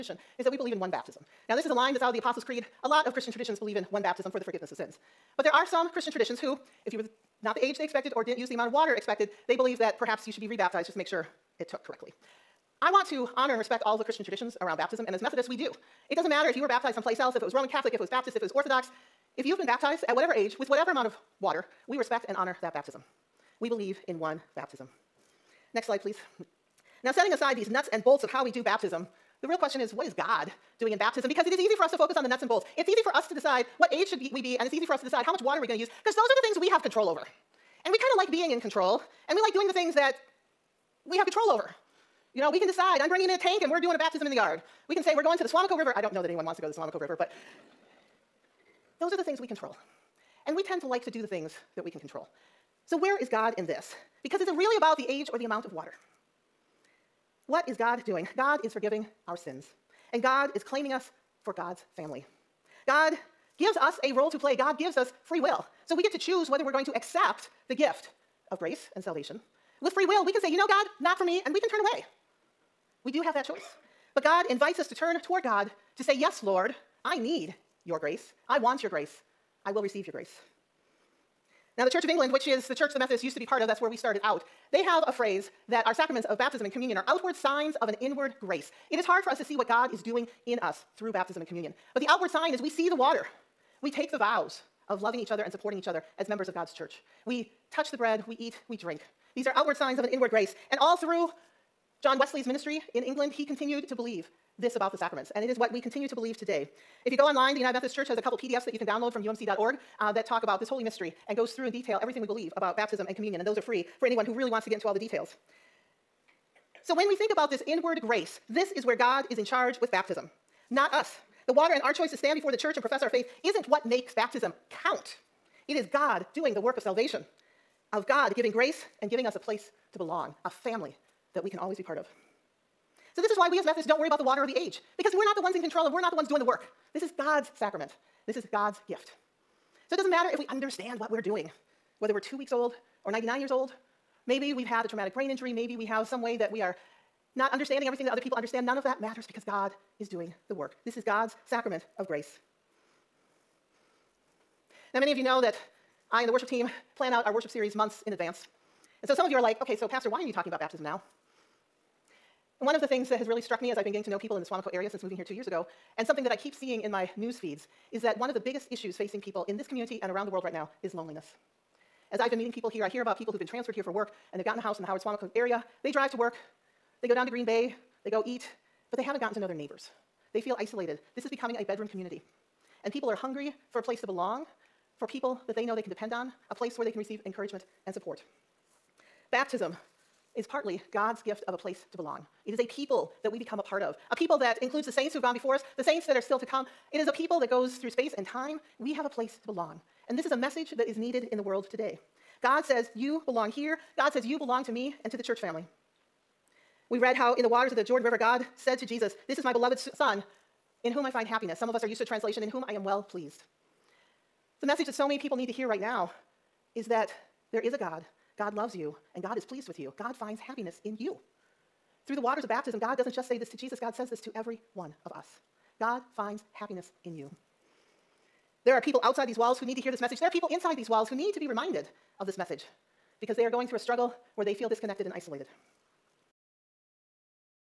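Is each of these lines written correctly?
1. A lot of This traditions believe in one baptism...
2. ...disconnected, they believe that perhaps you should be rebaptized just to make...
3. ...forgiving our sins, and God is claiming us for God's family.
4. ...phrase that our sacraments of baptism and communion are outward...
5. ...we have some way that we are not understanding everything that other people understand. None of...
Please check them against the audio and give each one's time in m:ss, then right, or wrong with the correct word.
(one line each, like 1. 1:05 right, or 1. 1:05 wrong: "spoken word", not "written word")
1. 0:02 wrong: "Christian", not "This"
2. 0:08 wrong: "expected", not "disconnected"
3. 0:58 right
4. 1:25 right
5. 2:25 right.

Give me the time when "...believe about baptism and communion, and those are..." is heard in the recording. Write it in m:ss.
1:52.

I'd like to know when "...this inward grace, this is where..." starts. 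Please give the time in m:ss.
1:57.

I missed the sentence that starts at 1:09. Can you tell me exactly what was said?
With free will, we can say, you know, God, not for me, and we can turn away.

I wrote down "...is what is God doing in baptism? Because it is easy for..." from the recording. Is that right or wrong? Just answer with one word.
right.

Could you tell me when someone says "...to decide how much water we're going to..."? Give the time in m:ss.
0:35.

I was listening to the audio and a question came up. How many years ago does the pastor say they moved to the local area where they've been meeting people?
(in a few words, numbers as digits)
2.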